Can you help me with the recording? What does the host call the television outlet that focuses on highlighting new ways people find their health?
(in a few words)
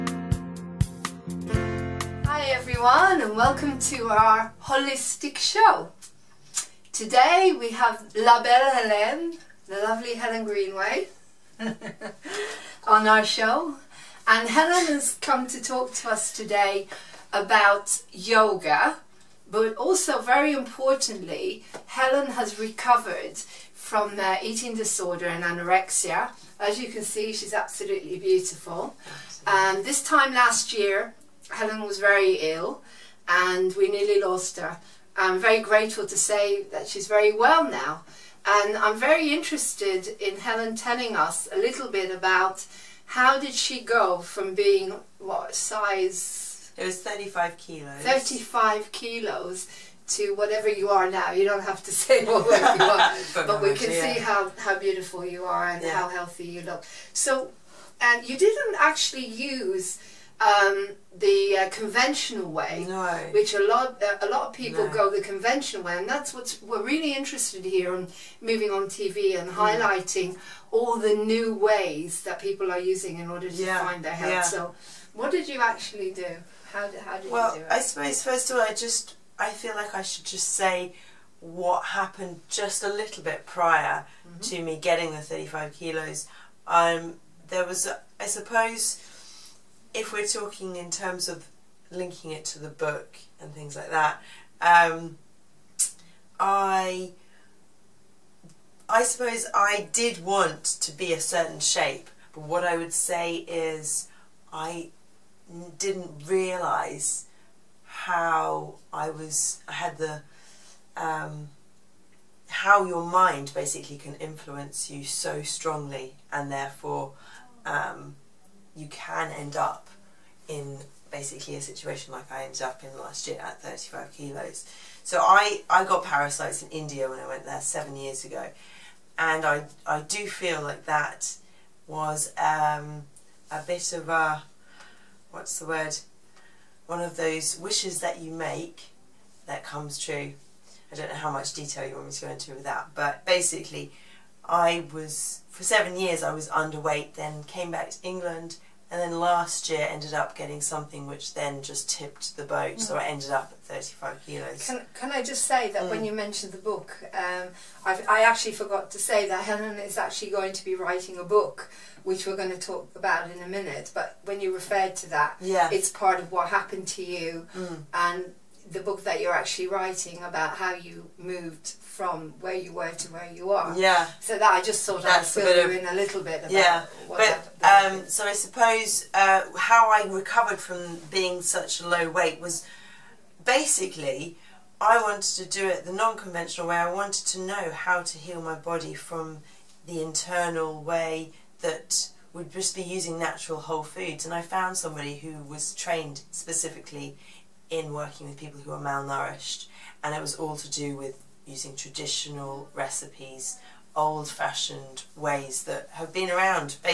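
Moving On TV.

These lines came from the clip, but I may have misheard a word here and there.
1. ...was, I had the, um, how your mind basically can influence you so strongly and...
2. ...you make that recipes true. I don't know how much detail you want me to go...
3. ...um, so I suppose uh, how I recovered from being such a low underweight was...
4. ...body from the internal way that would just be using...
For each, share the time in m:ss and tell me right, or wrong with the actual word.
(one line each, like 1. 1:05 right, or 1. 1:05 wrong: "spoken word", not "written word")
1. 1:49 right
2. 2:18 wrong: "comes", not "recipes"
3. 2:57 wrong: "weight", not "underweight"
4. 3:08 right.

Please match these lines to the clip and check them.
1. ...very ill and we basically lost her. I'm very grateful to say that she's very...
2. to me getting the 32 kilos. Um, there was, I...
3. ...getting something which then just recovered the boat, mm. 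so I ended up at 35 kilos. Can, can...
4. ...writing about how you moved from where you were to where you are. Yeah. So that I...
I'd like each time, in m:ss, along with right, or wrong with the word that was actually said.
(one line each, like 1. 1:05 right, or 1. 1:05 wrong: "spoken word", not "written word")
1. 0:31 wrong: "nearly", not "basically"
2. 1:24 wrong: "35", not "32"
3. 2:30 wrong: "tipped", not "recovered"
4. 2:49 right.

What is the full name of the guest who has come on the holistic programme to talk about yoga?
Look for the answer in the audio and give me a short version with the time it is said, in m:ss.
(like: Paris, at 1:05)
Helen Greenway, at 0:10.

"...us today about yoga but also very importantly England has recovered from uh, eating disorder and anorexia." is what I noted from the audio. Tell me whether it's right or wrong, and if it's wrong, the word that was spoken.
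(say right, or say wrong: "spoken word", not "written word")
wrong: "Helen", not "England".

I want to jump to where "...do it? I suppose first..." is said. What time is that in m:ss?
1:17.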